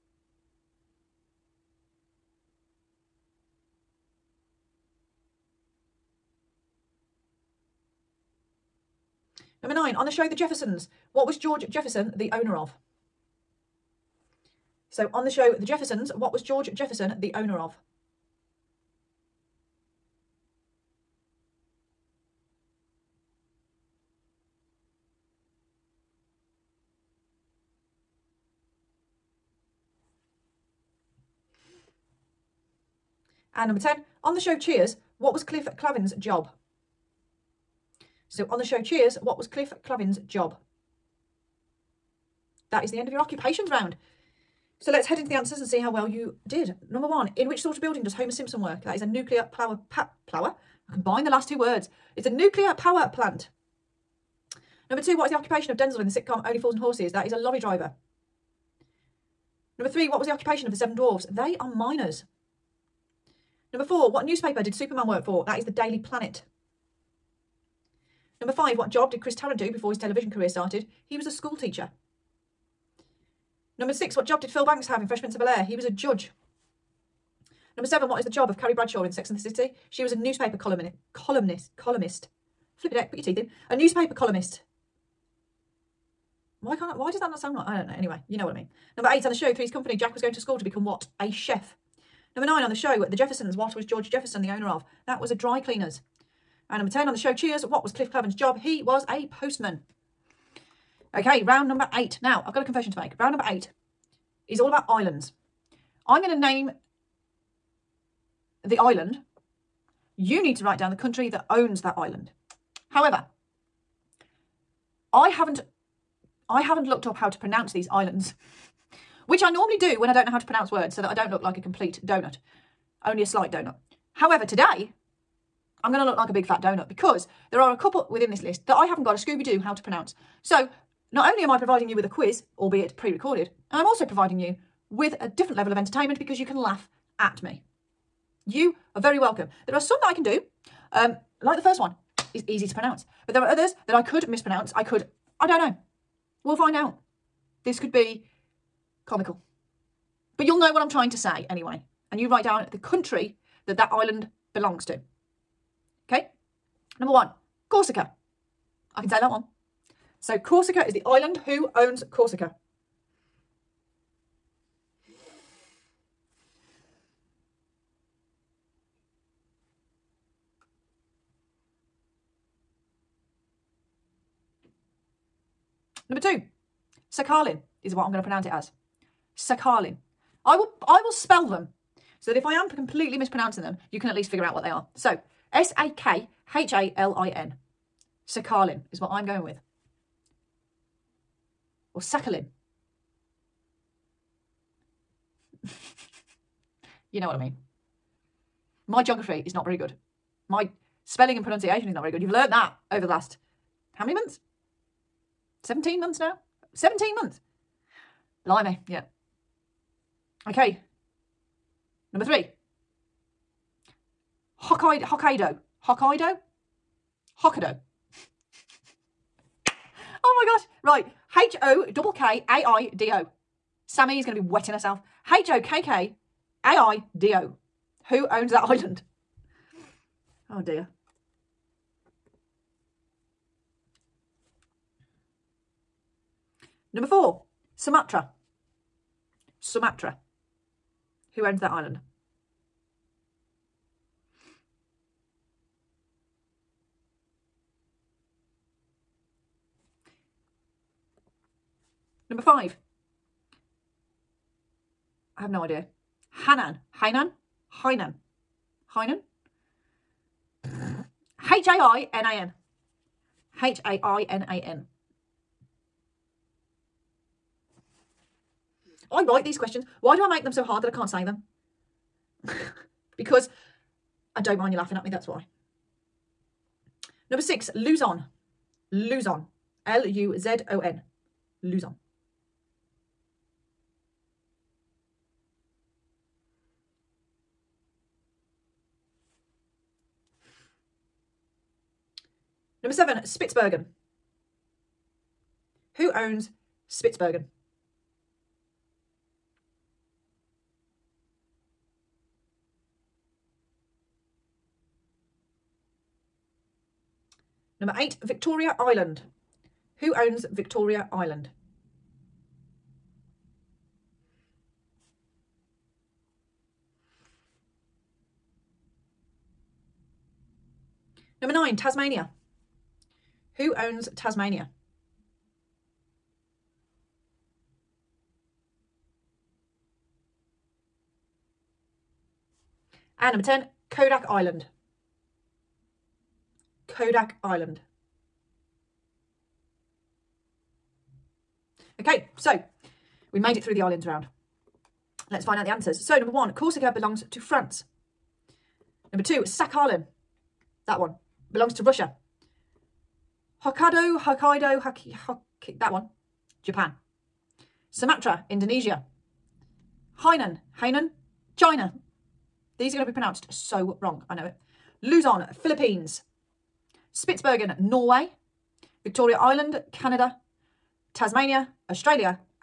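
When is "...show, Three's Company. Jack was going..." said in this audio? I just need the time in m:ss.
1:29.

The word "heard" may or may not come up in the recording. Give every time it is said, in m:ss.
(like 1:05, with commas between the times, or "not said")
not said.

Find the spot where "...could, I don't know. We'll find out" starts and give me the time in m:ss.
2:24.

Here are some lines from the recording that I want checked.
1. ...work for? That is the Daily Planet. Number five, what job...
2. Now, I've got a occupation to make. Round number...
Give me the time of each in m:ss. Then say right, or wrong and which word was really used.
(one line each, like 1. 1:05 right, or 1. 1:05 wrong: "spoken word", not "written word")
1. 1:05 right
2. 1:42 wrong: "confession", not "occupation".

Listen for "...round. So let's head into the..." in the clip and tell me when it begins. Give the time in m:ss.
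0:43.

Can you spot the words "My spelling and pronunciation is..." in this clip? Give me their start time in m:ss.
3:20.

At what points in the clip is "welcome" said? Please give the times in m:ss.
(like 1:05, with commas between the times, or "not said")
2:19.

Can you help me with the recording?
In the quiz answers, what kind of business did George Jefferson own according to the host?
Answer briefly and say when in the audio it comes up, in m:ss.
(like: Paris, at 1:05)
A dry cleaner's, at 1:35.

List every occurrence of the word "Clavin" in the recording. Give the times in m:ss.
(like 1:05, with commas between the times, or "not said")
0:35, 0:39, 1:38.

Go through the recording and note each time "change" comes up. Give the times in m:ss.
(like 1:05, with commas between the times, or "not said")
not said.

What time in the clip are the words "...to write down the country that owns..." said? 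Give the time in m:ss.
1:50.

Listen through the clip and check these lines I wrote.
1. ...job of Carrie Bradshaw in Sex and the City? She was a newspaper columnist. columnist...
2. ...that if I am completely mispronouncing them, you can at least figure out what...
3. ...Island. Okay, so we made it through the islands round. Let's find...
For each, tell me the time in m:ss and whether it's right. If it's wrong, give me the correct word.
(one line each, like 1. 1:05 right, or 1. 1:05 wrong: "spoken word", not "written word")
1. 1:18 right
2. 3:02 right
3. 5:37 right.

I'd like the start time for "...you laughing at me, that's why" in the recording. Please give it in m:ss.
4:34.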